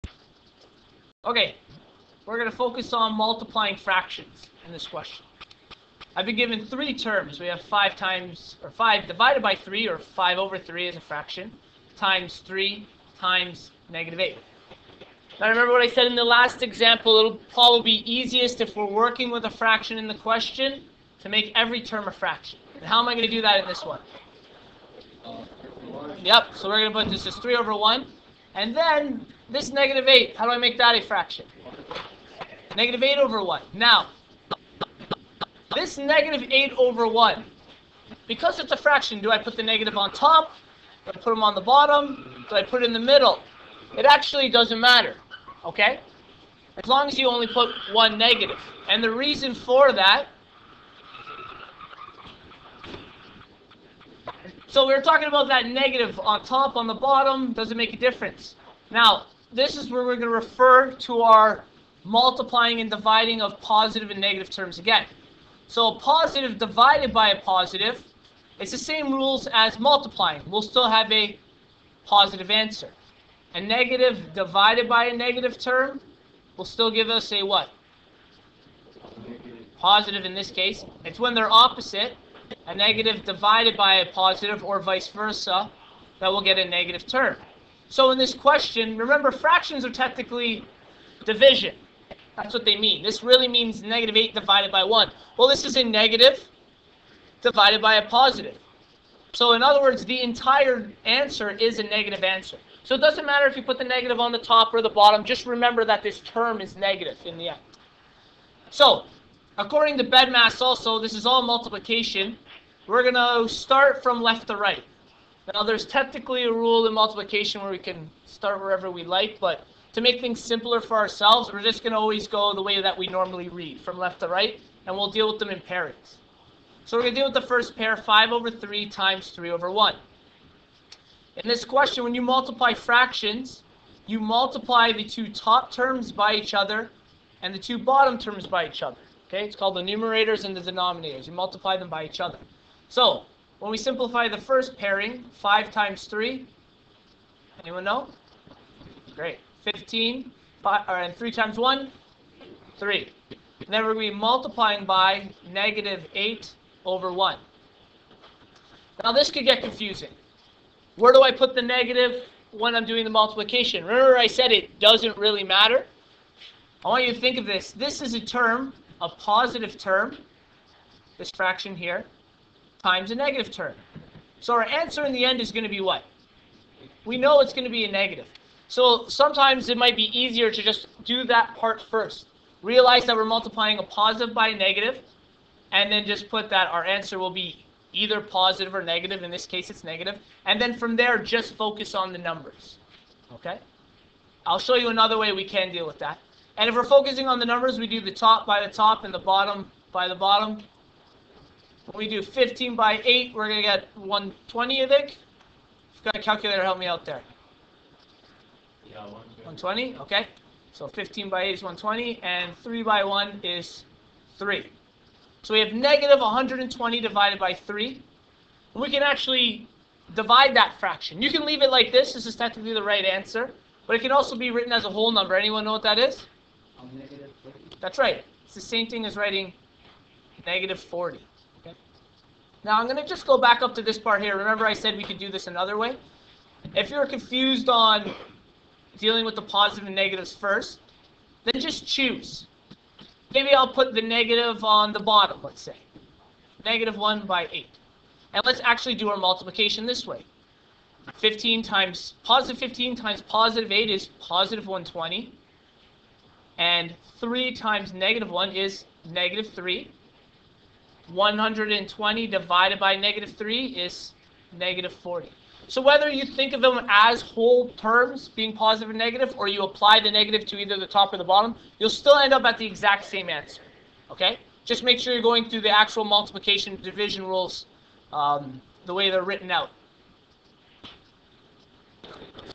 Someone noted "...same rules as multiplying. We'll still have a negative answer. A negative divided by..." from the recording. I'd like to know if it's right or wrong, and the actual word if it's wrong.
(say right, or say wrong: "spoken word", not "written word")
wrong: "positive", not "negative".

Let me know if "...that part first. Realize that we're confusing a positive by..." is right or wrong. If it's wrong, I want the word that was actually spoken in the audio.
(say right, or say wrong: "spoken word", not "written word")
wrong: "multiplying", not "confusing".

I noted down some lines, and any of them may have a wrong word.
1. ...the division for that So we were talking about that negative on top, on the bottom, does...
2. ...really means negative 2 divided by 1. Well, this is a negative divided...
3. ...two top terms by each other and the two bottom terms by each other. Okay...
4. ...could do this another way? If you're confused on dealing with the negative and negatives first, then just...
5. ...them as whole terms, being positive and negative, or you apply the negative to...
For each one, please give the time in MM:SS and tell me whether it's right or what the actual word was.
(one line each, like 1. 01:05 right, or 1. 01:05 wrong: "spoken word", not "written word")
1. 00:49 wrong: "reason", not "division"
2. 01:33 wrong: "8", not "2"
3. 02:15 right
4. 03:55 wrong: "positive", not "negative"
5. 04:26 right.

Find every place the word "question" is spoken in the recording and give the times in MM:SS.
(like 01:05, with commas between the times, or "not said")
00:04, 00:20, 01:28, 02:11.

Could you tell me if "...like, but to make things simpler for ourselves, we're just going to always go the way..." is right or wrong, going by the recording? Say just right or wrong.
right.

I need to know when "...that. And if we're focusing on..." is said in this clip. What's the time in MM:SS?
03:15.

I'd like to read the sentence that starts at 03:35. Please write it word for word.
So we have negative 120 divided by 3.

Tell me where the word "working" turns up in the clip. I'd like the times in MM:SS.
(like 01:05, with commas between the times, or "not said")
00:18.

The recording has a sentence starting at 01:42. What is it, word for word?
So it doesn't matter if you put the negative on the top or the bottom.